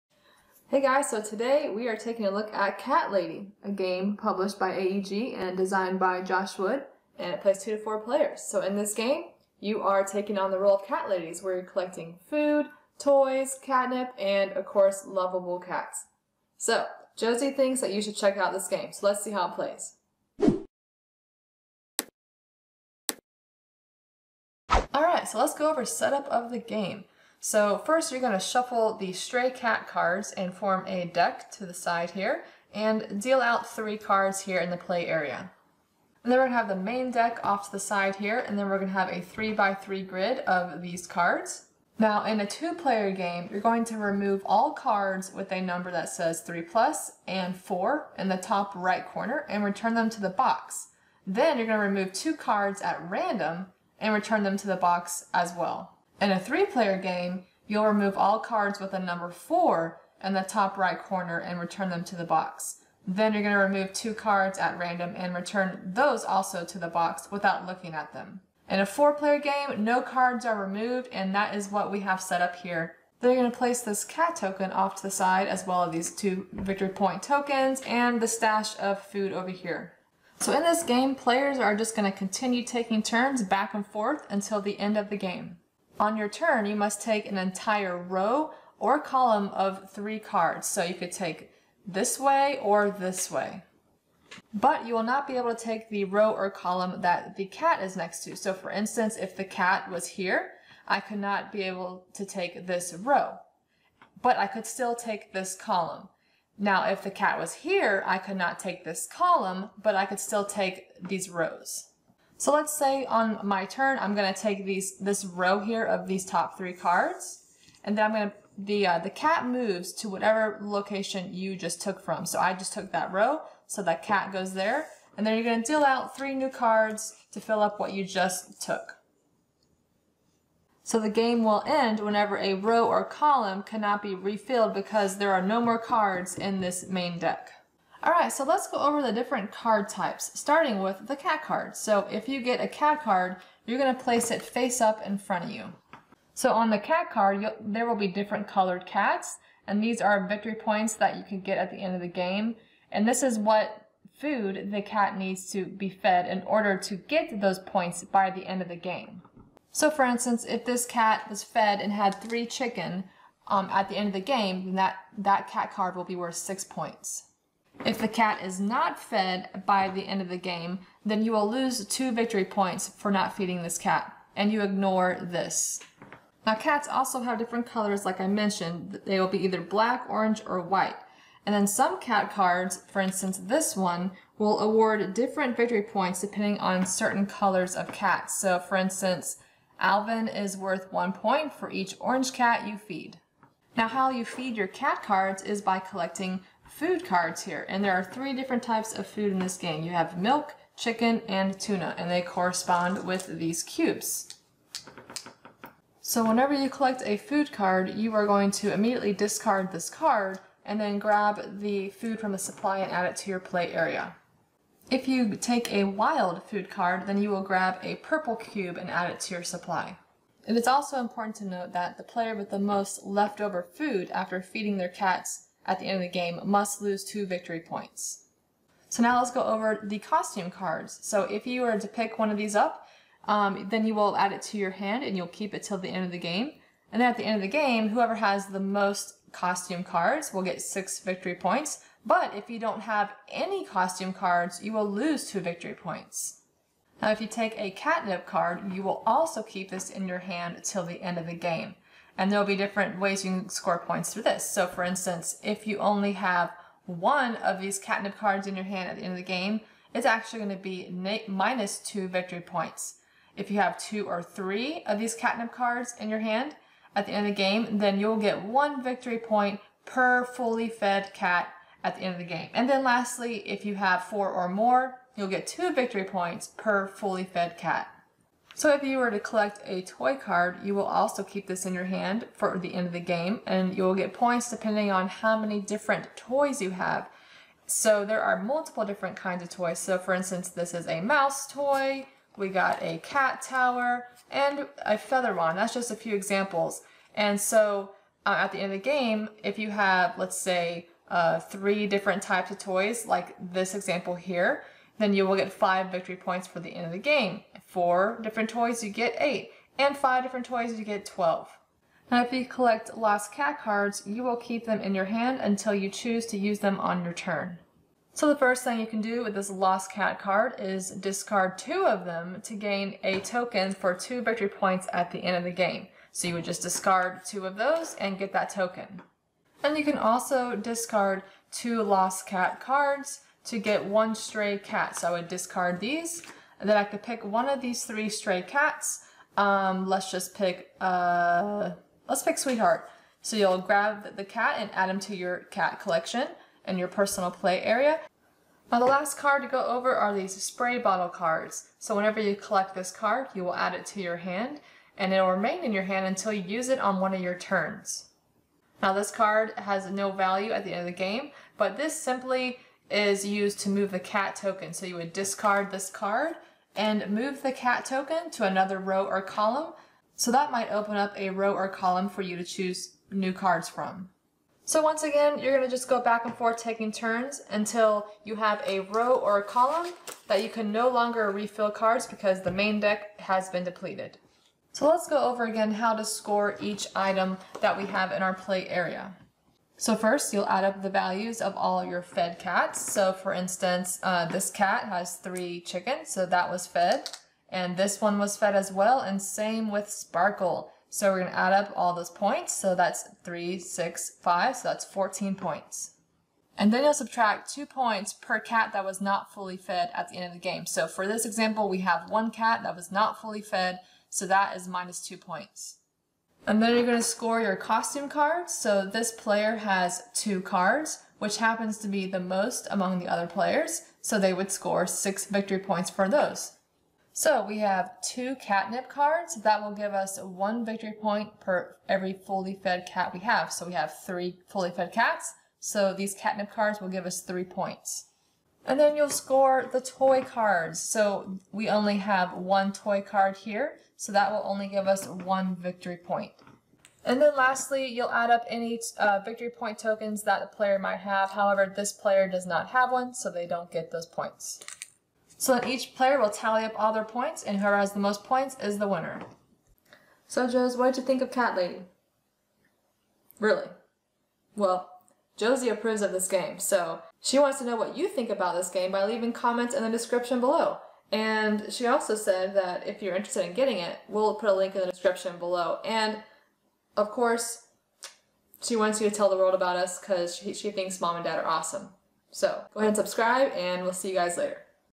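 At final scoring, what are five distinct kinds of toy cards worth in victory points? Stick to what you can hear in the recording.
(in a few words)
12.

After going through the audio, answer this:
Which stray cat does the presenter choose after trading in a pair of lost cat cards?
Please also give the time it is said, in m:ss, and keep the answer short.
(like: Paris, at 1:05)
Sweetheart, at 5:42.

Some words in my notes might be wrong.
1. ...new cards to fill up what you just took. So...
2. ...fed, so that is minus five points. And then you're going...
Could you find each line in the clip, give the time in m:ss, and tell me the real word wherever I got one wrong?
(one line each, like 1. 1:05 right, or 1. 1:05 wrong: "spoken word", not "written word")
1. 2:06 right
2. 6:53 wrong: "two", not "five".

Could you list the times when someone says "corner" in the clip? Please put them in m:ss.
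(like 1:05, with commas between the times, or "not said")
0:49, 1:01.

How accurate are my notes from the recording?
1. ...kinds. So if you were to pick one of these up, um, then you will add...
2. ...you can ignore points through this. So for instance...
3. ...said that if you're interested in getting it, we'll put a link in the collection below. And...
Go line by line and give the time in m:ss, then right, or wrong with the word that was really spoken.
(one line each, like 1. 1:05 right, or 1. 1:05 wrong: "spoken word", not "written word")
1. 3:50 wrong: "cards", not "kinds"
2. 4:13 wrong: "score", not "ignore"
3. 7:52 wrong: "description", not "collection".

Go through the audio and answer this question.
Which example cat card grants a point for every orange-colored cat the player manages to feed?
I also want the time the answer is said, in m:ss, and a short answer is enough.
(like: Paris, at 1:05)
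Alvin, at 3:09.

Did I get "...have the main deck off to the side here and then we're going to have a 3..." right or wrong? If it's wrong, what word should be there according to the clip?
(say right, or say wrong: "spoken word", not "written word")
right.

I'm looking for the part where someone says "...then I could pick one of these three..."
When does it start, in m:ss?
5:36.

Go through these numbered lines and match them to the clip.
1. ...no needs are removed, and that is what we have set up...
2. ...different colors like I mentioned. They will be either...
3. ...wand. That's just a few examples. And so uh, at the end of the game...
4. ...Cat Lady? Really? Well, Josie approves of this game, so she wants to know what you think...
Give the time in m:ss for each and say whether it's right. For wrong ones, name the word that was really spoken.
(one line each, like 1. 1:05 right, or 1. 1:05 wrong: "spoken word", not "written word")
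1. 1:09 wrong: "cards", not "needs"
2. 2:57 right
3. 4:55 right
4. 7:41 right.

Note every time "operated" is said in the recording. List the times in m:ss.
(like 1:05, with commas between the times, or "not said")
not said.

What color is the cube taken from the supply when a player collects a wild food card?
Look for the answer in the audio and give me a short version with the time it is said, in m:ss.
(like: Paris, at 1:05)
Purple, at 3:37.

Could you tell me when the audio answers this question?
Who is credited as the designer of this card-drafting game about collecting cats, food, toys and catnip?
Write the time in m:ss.
0:06.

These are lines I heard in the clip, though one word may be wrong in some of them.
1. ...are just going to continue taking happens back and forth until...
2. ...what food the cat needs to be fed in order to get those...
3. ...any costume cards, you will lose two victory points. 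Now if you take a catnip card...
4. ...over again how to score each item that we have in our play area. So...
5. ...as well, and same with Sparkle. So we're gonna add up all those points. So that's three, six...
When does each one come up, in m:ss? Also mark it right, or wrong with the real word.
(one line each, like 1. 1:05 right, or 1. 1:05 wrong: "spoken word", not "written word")
1. 1:21 wrong: "turns", not "happens"
2. 2:33 right
3. 4:03 right
4. 6:25 right
5. 6:38 right.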